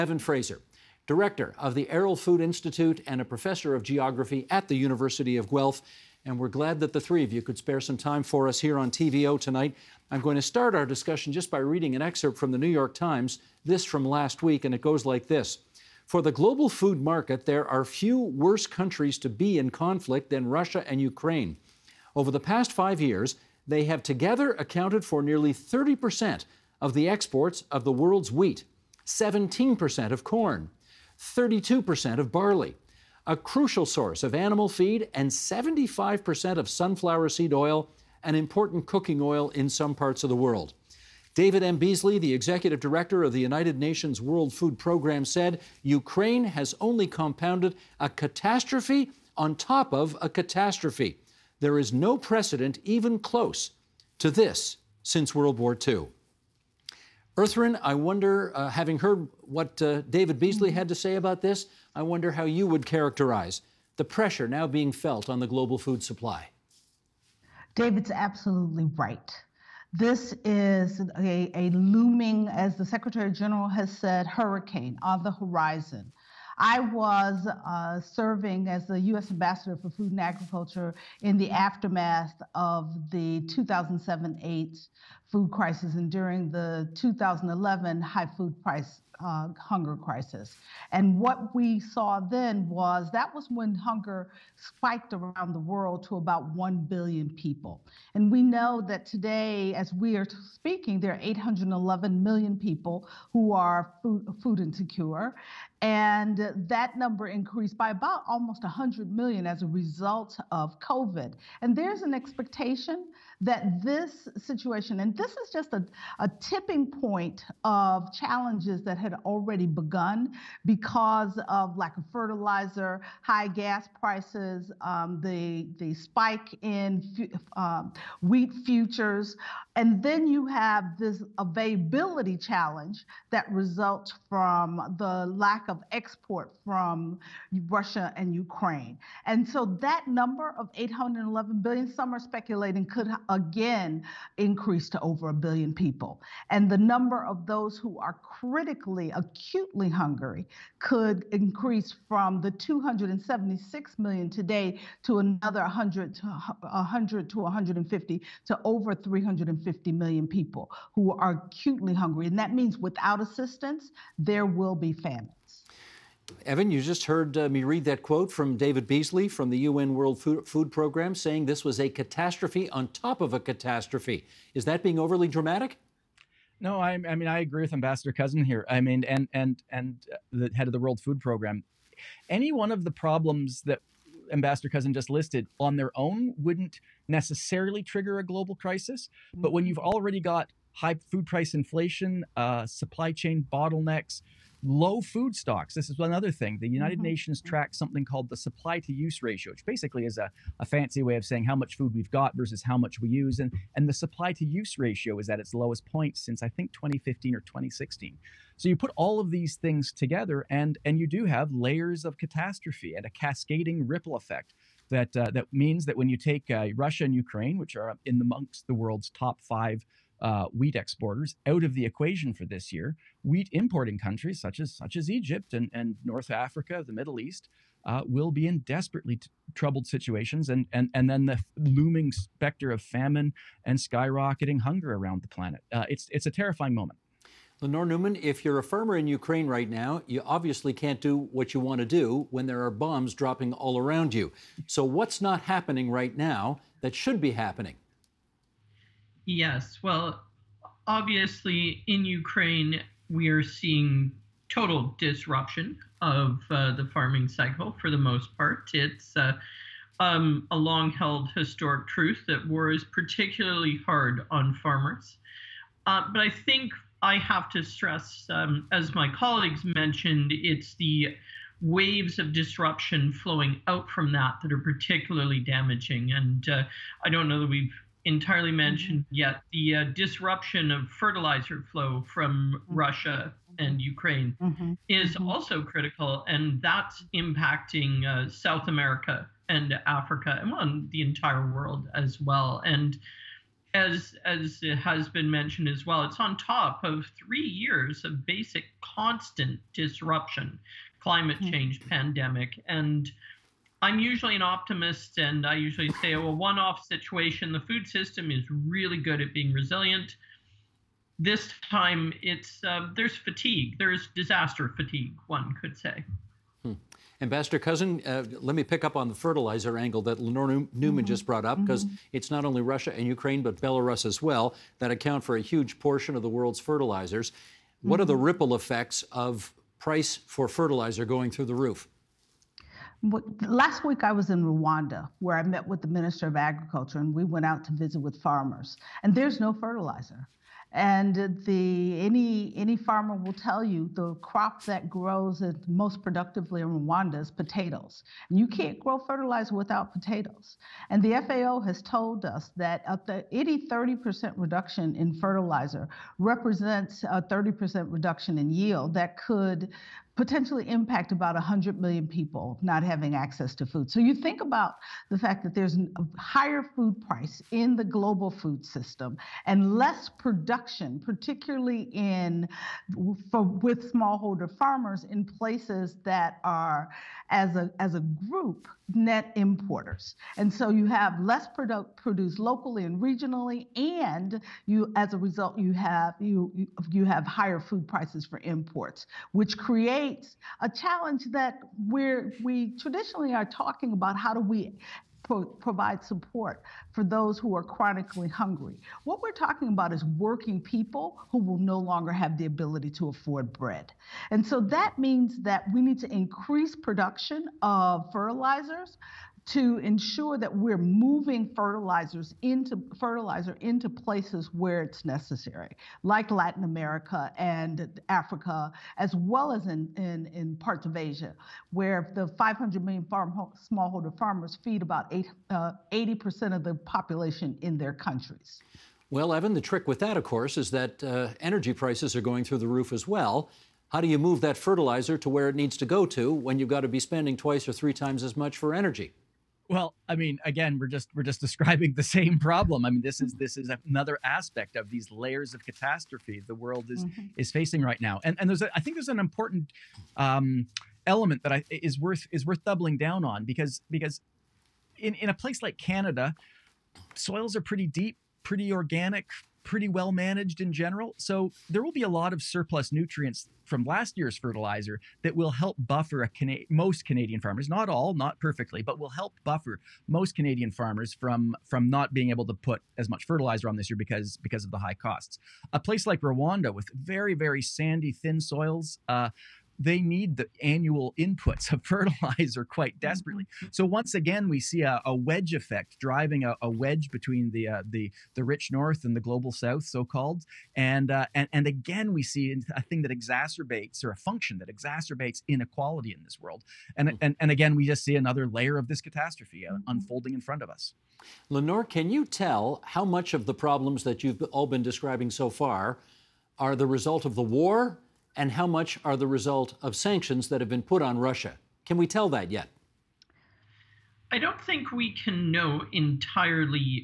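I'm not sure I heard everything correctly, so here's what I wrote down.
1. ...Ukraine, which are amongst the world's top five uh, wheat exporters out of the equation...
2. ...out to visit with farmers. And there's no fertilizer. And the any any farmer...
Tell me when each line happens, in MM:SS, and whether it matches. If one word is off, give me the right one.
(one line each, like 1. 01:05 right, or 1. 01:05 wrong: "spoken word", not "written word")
1. 03:37 right
2. 05:37 right.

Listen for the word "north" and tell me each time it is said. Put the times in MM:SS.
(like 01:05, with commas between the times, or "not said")
03:46, 08:08.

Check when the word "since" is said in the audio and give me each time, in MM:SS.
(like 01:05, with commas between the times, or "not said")
00:55, 03:26.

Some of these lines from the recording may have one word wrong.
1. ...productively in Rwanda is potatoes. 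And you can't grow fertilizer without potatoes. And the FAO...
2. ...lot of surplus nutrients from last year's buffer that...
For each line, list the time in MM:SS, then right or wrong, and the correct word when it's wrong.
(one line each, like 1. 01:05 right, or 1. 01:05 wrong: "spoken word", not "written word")
1. 05:46 right
2. 07:42 wrong: "fertilizer", not "buffer".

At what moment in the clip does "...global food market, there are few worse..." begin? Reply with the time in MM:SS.
00:16.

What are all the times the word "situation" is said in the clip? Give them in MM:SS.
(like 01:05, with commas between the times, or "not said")
01:54, 03:49, 05:06.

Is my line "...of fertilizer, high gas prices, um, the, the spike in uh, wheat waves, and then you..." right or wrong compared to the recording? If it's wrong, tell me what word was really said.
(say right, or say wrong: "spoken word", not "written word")
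wrong: "futures", not "waves".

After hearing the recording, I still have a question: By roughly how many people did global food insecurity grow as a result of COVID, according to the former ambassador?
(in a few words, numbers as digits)
almost 100 million.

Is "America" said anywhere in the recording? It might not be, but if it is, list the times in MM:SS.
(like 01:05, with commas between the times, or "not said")
04:48, 06:56.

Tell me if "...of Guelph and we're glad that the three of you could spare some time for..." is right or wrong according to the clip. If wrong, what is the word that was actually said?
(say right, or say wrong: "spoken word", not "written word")
right.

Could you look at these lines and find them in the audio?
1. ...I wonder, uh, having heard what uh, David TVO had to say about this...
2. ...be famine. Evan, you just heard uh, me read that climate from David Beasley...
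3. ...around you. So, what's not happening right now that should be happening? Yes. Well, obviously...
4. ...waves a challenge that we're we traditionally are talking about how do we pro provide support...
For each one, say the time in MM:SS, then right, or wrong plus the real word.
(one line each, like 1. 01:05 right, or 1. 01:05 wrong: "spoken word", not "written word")
1. 00:57 wrong: "Beasley", not "TVO"
2. 02:44 wrong: "quote", not "climate"
3. 04:03 right
4. 06:29 wrong: "creates", not "waves".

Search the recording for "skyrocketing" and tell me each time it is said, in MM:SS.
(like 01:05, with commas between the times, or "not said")
03:53.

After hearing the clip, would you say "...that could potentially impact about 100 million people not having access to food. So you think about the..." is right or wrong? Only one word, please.
right.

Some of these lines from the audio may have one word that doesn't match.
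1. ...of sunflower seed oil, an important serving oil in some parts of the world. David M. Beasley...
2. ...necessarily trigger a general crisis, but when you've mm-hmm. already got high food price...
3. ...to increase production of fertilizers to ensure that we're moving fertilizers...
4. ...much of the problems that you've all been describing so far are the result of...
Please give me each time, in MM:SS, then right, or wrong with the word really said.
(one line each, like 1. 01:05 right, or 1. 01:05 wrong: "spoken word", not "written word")
1. 00:36 wrong: "cooking", not "serving"
2. 03:07 wrong: "global", not "general"
3. 06:45 right
4. 08:23 right.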